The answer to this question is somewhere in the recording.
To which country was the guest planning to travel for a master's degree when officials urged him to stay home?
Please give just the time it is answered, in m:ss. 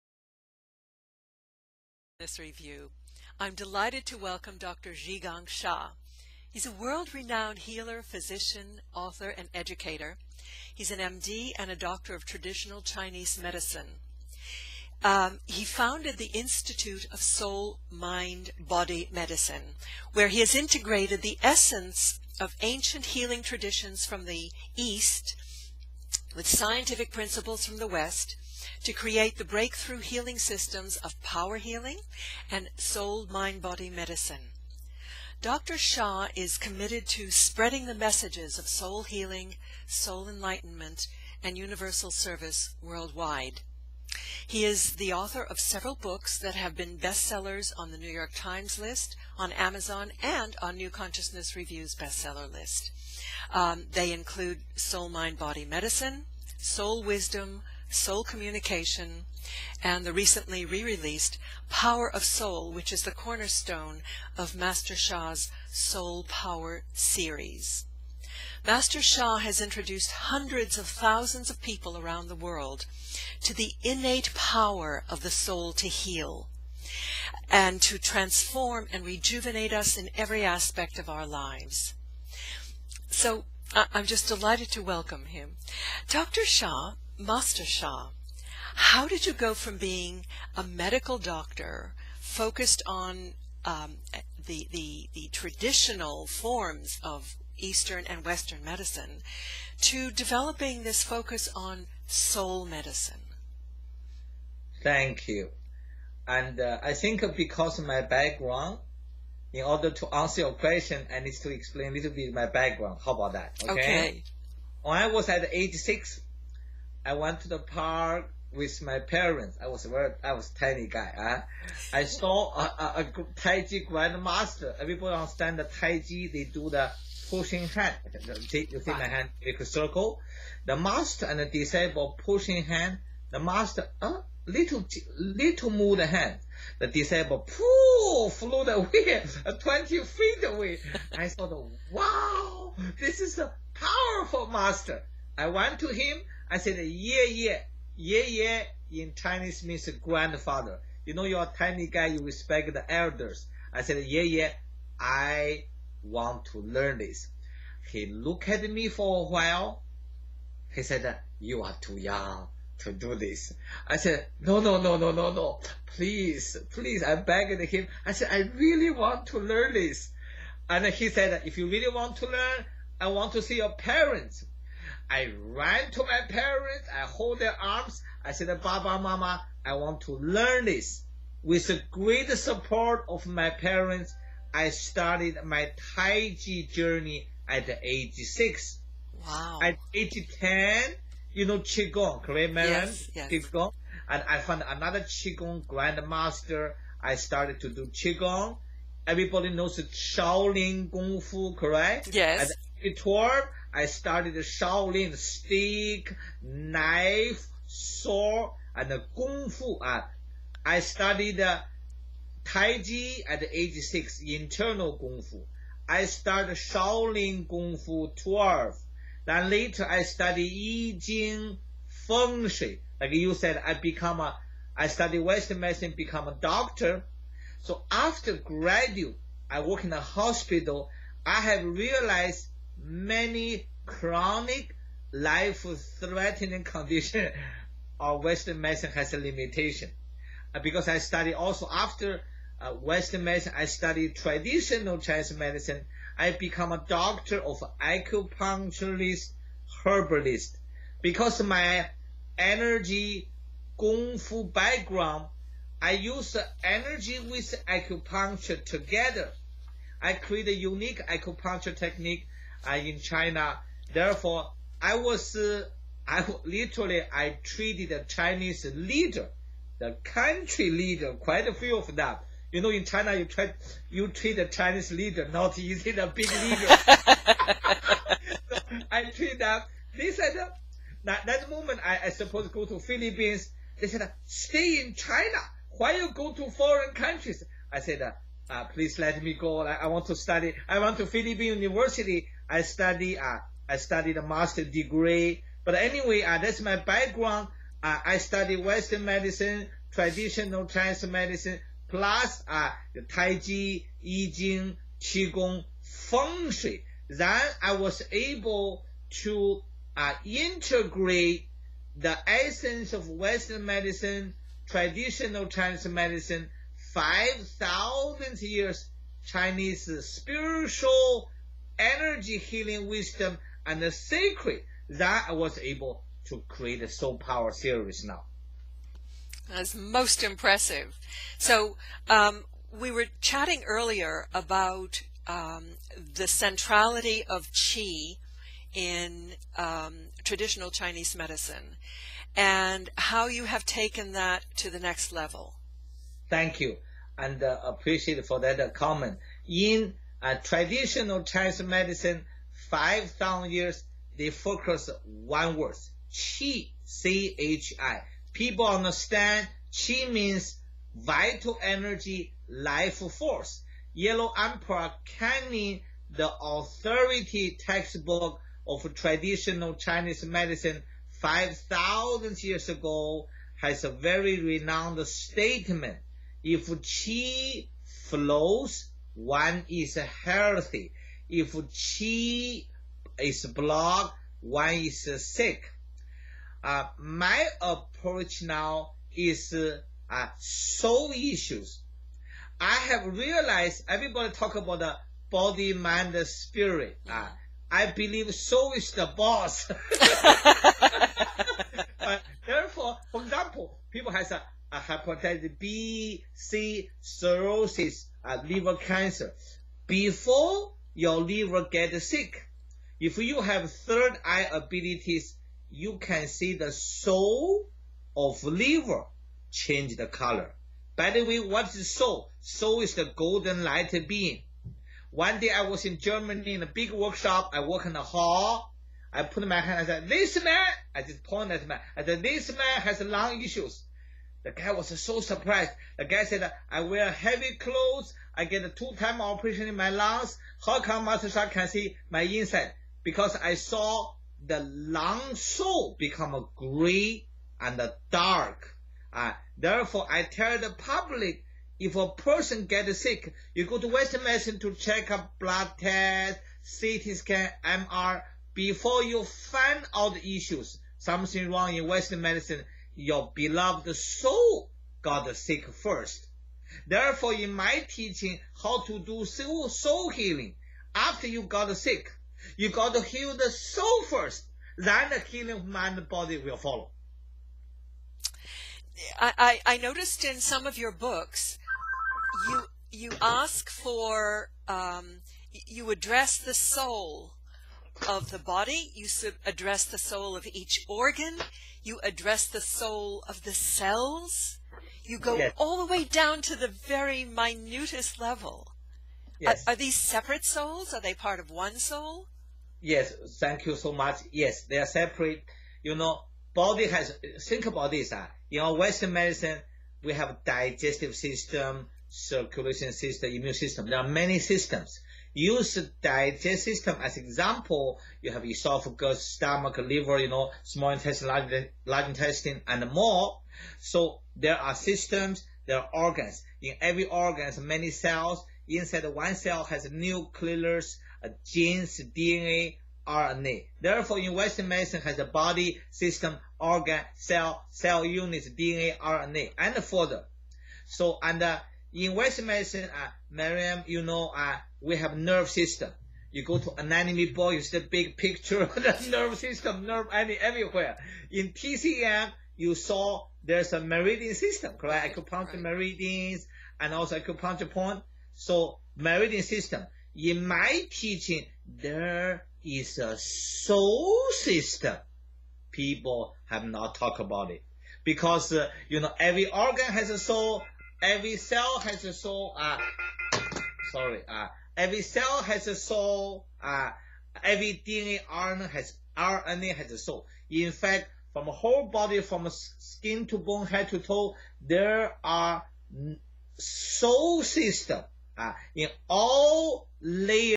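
4:42.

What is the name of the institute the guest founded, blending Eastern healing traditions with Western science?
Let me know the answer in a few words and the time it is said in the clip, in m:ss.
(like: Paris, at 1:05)
Institute of Soul, Mind, Body Medicine, at 0:16.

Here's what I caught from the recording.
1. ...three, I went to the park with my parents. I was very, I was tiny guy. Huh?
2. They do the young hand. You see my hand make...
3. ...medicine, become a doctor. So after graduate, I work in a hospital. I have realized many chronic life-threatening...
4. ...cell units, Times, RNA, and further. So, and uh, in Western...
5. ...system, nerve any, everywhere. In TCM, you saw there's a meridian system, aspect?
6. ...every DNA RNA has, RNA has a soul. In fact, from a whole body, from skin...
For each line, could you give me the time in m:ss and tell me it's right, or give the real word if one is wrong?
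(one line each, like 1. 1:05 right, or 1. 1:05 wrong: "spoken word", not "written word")
1. 1:55 wrong: "six", not "three"
2. 2:06 wrong: "pushing", not "young"
3. 3:45 right
4. 8:57 wrong: "DNA", not "Times"
5. 9:09 wrong: "correct", not "aspect"
6. 9:37 right.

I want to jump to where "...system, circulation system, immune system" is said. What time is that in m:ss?
8:31.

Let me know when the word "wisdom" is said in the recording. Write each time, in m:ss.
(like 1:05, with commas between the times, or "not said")
0:57, 5:22.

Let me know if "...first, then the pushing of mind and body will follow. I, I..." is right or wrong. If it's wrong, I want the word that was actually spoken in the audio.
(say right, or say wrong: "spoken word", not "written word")
wrong: "healing", not "pushing".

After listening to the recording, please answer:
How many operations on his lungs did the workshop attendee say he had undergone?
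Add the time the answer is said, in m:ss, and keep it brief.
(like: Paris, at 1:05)
2, at 7:18.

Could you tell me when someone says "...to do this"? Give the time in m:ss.
2:42.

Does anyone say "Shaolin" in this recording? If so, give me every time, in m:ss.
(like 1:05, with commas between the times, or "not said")
3:19, 3:24, 3:36.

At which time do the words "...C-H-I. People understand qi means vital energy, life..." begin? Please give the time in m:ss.
5:56.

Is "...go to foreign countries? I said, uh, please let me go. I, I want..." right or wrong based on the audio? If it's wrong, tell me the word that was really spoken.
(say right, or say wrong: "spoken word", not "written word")
right.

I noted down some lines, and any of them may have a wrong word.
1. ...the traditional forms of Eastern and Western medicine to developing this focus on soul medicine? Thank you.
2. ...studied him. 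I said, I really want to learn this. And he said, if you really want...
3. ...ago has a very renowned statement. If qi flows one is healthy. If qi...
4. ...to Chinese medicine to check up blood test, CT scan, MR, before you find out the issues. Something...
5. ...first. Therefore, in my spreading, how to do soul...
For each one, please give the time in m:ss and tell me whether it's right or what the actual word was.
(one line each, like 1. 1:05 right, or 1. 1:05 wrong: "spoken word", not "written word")
1. 1:35 right
2. 2:47 wrong: "begged", not "studied"
3. 6:12 right
4. 7:33 wrong: "Western", not "Chinese"
5. 7:45 wrong: "teaching", not "spreading".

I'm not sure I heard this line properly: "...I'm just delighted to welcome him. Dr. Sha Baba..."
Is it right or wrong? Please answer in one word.
wrong.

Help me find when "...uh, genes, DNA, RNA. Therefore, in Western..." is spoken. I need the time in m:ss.
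8:51.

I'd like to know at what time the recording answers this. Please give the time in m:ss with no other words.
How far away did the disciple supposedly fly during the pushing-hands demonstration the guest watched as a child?
2:19.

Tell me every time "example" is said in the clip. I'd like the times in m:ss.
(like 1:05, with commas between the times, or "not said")
6:43, 8:37.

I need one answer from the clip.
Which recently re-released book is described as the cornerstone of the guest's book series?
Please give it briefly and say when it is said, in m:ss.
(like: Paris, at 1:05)
Power of Soul, at 1:01.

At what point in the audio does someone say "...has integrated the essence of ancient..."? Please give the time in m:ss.
0:20.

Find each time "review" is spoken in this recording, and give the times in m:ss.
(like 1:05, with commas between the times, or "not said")
0:02, 0:51.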